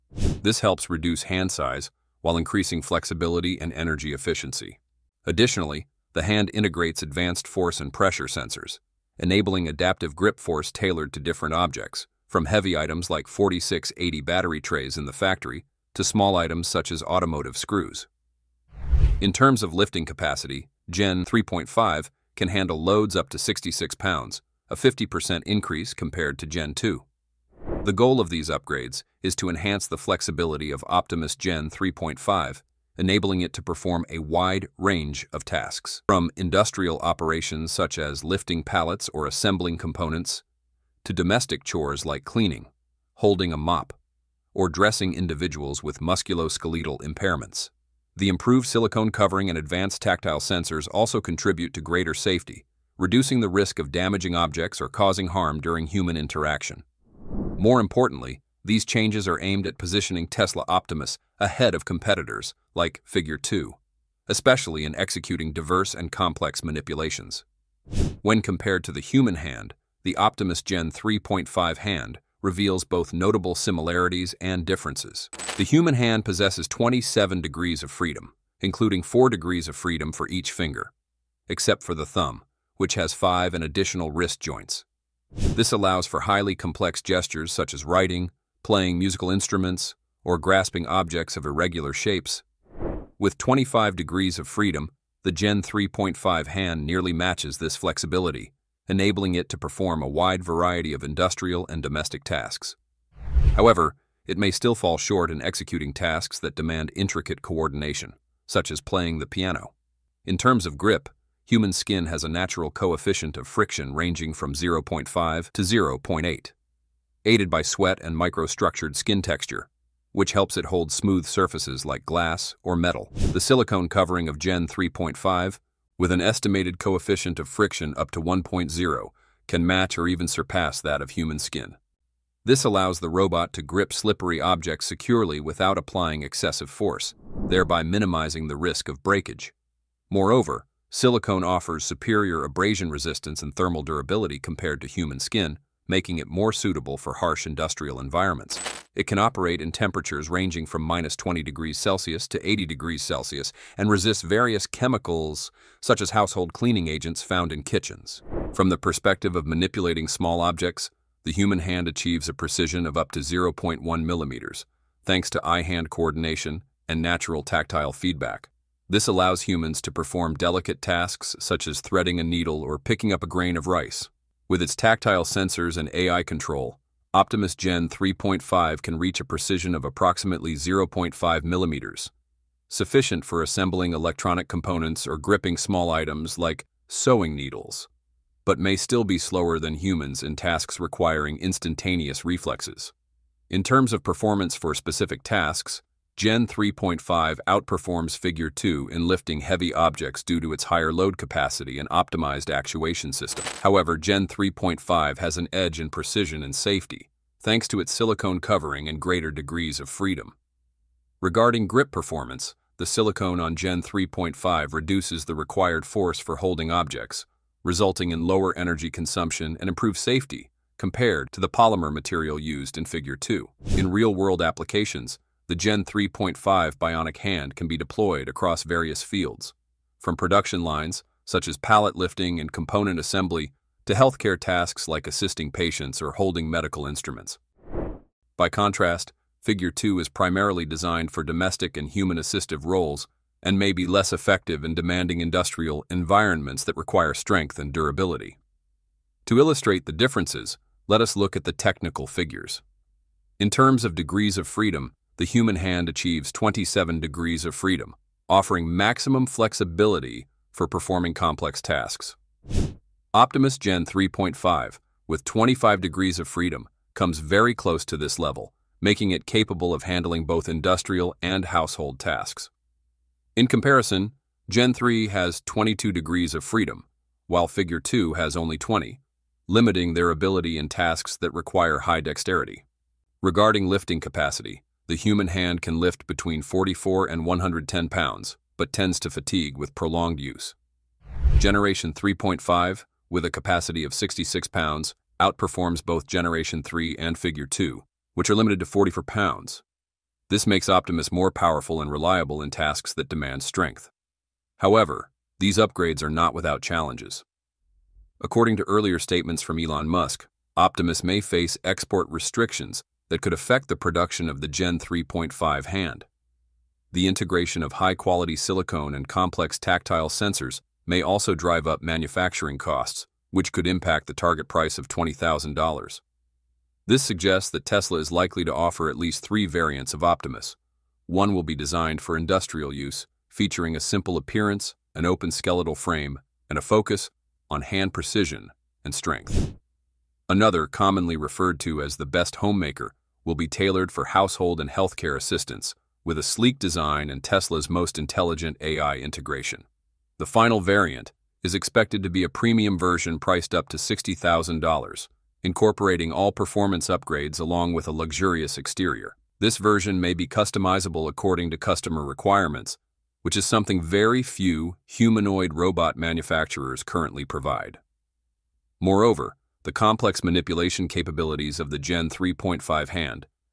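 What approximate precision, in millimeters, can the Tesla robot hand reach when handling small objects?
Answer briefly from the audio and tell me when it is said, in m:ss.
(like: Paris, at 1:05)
0.5 millimeters, at 3:00.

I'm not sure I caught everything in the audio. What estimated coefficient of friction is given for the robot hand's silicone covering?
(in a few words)
1.0.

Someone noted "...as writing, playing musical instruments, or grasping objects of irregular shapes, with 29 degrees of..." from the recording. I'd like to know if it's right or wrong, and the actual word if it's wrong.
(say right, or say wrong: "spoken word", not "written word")
wrong: "25", not "29".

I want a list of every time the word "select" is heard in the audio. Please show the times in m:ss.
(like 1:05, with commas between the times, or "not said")
not said.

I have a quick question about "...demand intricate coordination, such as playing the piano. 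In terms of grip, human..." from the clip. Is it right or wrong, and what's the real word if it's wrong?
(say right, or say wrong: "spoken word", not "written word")
right.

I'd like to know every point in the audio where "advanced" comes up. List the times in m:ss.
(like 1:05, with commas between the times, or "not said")
0:07, 0:49.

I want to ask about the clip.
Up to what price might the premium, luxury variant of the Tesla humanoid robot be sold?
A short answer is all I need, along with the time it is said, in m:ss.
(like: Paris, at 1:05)
$60,000, at 5:53.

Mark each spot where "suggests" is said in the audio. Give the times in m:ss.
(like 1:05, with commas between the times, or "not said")
5:27.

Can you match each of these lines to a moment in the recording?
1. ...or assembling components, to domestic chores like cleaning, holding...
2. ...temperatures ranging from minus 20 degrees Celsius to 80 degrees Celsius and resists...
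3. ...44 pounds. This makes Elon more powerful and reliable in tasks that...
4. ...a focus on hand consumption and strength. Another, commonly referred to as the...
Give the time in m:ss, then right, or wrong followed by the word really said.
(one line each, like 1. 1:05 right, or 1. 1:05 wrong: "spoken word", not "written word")
1. 0:39 right
2. 2:29 right
3. 4:58 wrong: "Optimus", not "Elon"
4. 5:36 wrong: "precision", not "consumption".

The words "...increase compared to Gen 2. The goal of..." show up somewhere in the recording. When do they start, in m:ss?
0:25.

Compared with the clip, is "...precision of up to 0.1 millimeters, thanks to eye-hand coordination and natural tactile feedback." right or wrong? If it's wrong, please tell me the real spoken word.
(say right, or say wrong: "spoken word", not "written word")
right.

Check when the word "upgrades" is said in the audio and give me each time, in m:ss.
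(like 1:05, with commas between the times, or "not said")
0:28, 5:05, 5:56.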